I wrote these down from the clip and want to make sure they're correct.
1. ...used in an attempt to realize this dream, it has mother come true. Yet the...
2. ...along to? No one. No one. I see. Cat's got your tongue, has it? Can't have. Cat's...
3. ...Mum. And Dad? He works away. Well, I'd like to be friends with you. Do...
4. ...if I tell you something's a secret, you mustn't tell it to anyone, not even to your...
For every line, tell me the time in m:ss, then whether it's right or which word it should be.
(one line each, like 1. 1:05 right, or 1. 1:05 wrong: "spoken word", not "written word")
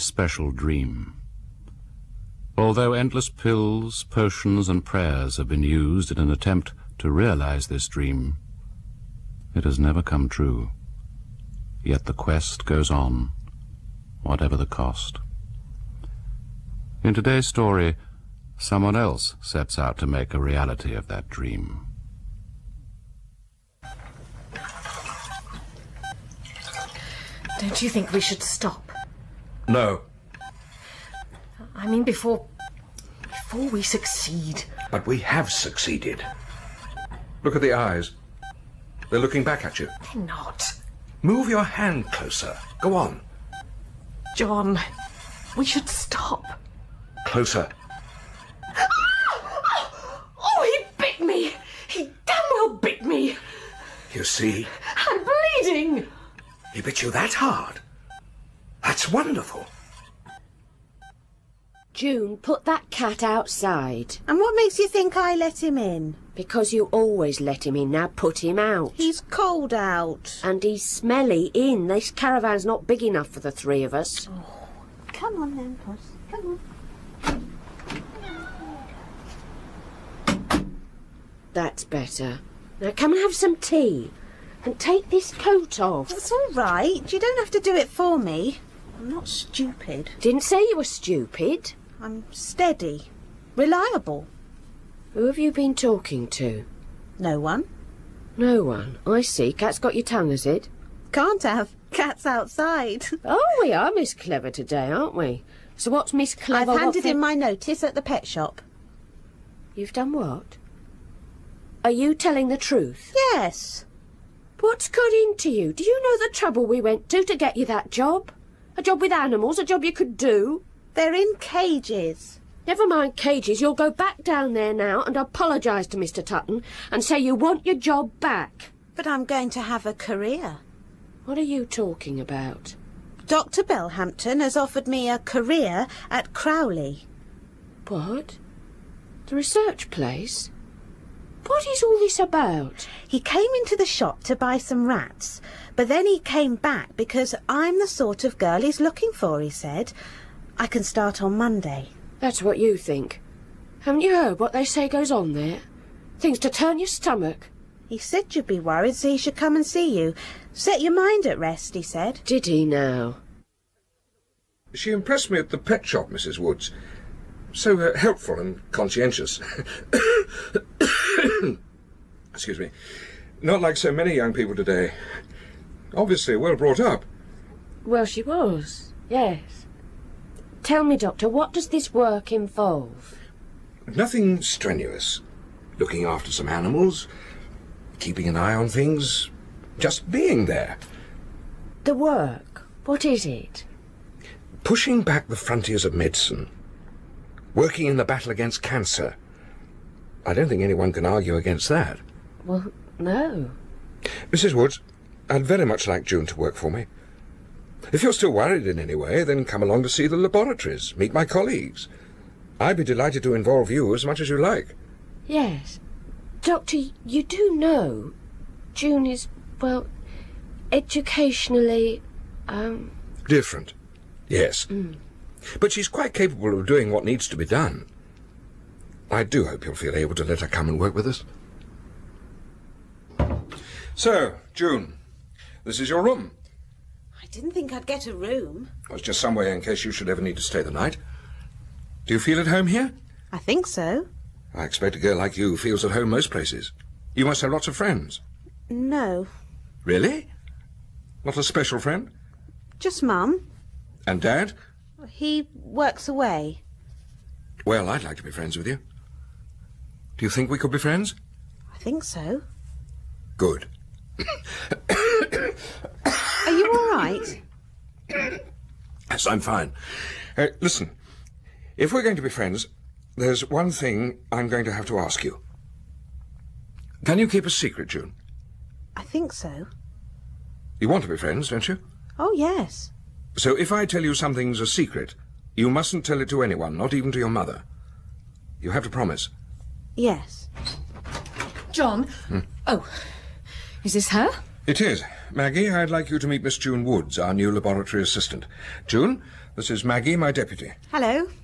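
1. 0:05 wrong: "never", not "mother"
2. 1:35 wrong: "talking", not "along"
3. 4:13 right
4. 4:43 right.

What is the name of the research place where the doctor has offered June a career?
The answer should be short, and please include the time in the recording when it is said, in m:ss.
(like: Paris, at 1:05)
Crowley, at 2:16.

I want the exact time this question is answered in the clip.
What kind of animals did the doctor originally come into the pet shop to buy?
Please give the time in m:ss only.
2:24.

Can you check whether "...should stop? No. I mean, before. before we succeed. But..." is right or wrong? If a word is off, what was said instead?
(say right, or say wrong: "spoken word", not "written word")
right.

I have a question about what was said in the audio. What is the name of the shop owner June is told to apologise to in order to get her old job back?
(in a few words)
Mr Tutton.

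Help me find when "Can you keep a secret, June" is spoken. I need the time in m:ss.
4:37.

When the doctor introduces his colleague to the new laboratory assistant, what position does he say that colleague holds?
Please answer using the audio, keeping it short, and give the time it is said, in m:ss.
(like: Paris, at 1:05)
Deputy, at 5:00.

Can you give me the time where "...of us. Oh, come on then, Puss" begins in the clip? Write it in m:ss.
1:13.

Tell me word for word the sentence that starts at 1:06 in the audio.
Because you always let him in, now put him out.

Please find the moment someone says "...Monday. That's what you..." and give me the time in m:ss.
2:31.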